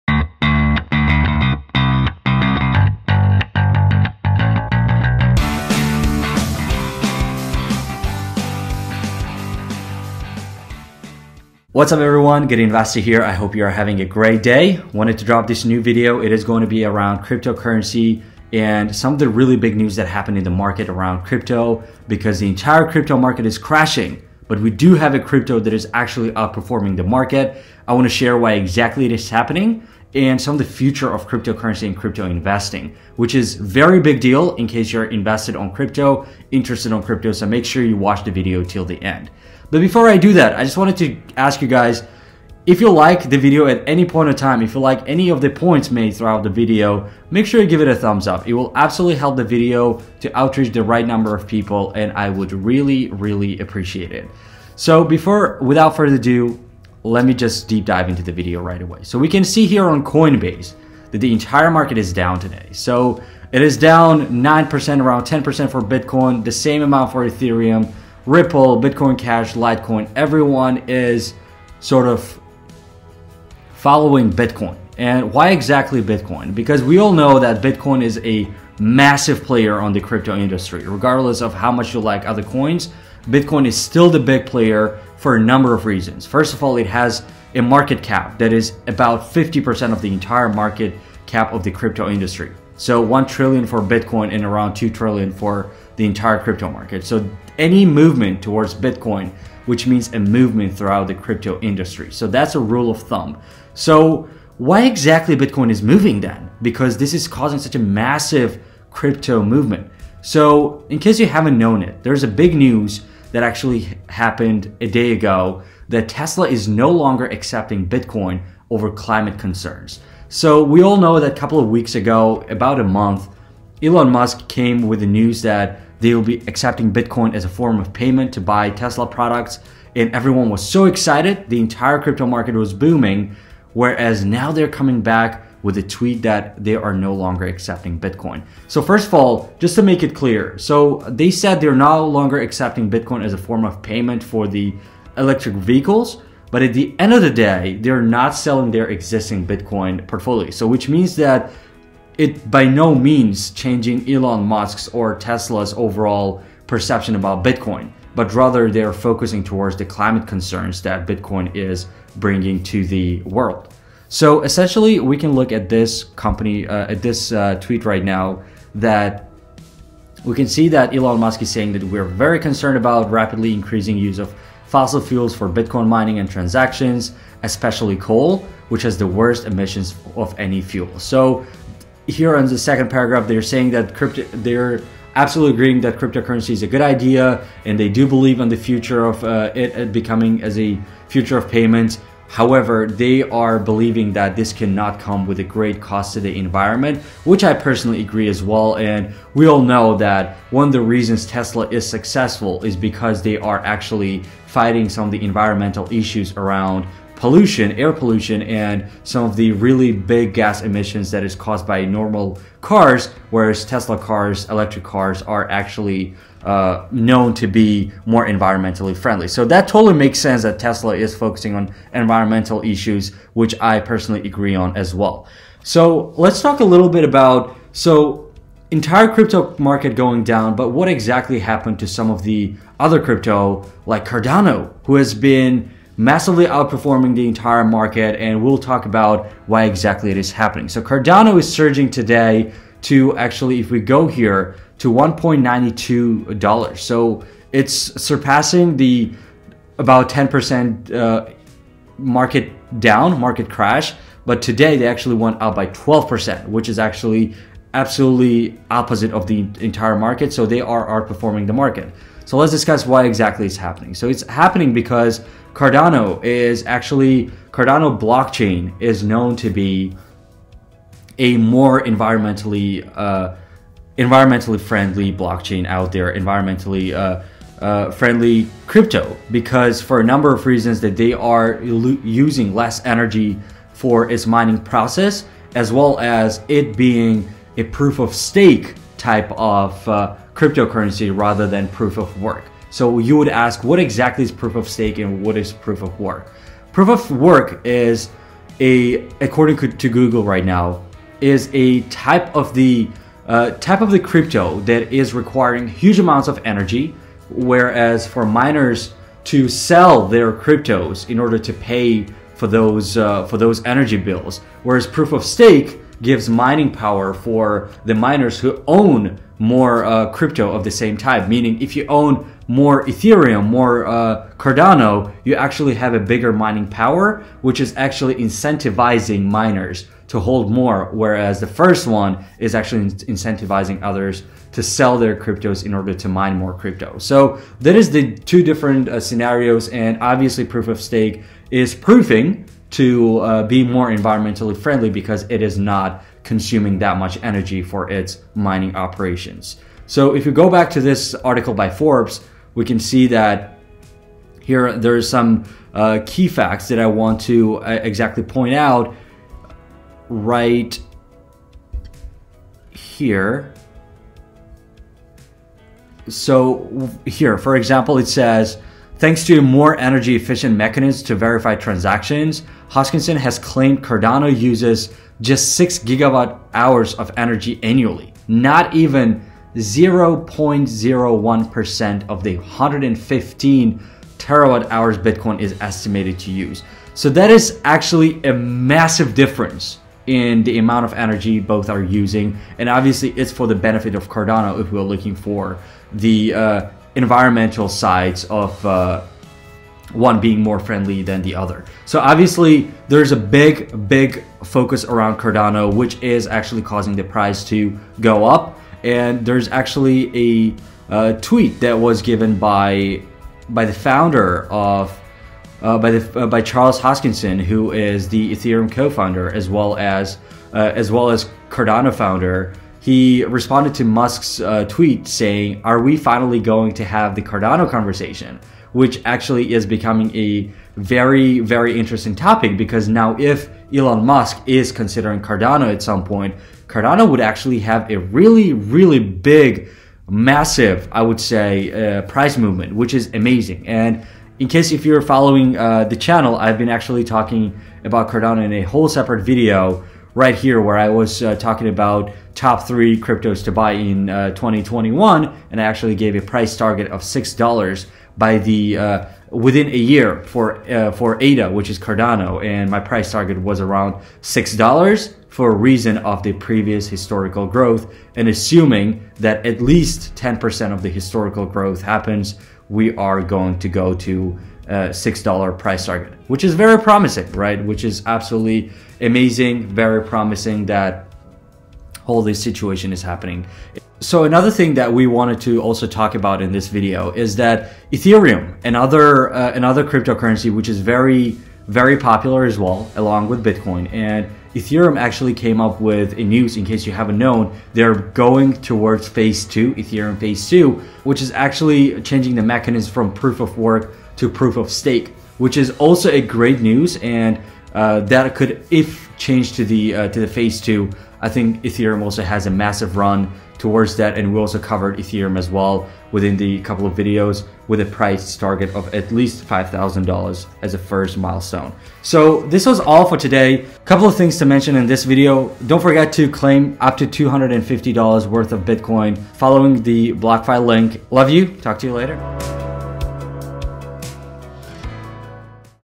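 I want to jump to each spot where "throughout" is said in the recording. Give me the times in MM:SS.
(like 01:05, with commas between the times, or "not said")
00:46, 01:40.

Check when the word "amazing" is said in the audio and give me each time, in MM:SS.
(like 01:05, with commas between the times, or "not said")
07:23, 07:58.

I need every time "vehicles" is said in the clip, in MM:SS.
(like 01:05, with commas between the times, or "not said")
02:25.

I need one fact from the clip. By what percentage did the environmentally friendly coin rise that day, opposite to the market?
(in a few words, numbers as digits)
12%.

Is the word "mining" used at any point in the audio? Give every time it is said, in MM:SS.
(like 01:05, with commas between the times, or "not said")
02:55, 04:44, 05:16, 05:26, 05:48.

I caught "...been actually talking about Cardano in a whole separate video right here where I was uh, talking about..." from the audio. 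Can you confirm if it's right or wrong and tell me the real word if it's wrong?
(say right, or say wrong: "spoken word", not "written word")
right.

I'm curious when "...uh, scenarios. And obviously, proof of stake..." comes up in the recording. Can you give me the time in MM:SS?
05:38.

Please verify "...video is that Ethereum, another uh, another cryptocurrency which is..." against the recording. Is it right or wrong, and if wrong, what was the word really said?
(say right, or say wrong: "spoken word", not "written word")
right.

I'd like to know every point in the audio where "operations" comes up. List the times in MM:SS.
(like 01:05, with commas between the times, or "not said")
05:48.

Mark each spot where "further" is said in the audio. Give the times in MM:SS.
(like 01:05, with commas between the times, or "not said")
00:55.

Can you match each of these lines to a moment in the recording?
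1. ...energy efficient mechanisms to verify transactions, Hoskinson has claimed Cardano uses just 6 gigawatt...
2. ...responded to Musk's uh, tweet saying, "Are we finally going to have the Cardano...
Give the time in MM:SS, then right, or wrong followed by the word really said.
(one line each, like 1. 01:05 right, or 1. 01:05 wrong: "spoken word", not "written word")
1. 06:09 right
2. 07:03 right.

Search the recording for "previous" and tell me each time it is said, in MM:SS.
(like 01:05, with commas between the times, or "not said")
07:46.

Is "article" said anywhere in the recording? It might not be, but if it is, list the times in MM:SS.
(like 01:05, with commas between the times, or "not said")
05:51.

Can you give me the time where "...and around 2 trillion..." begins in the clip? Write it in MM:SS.
01:34.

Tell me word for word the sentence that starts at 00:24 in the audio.
But we do have a crypto that is actually outperforming the market.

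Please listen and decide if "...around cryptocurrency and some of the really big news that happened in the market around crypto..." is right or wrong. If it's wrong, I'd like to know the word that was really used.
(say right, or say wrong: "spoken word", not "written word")
right.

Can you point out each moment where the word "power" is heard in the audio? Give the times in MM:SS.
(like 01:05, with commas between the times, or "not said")
05:16, 05:26.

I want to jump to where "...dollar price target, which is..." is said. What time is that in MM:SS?
07:55.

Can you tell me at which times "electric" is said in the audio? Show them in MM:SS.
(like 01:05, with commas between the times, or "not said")
02:25, 03:34.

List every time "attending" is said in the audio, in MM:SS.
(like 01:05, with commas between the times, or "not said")
not said.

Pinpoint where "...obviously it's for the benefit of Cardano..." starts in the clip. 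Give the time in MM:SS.
06:32.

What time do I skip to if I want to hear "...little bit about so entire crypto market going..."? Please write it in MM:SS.
03:46.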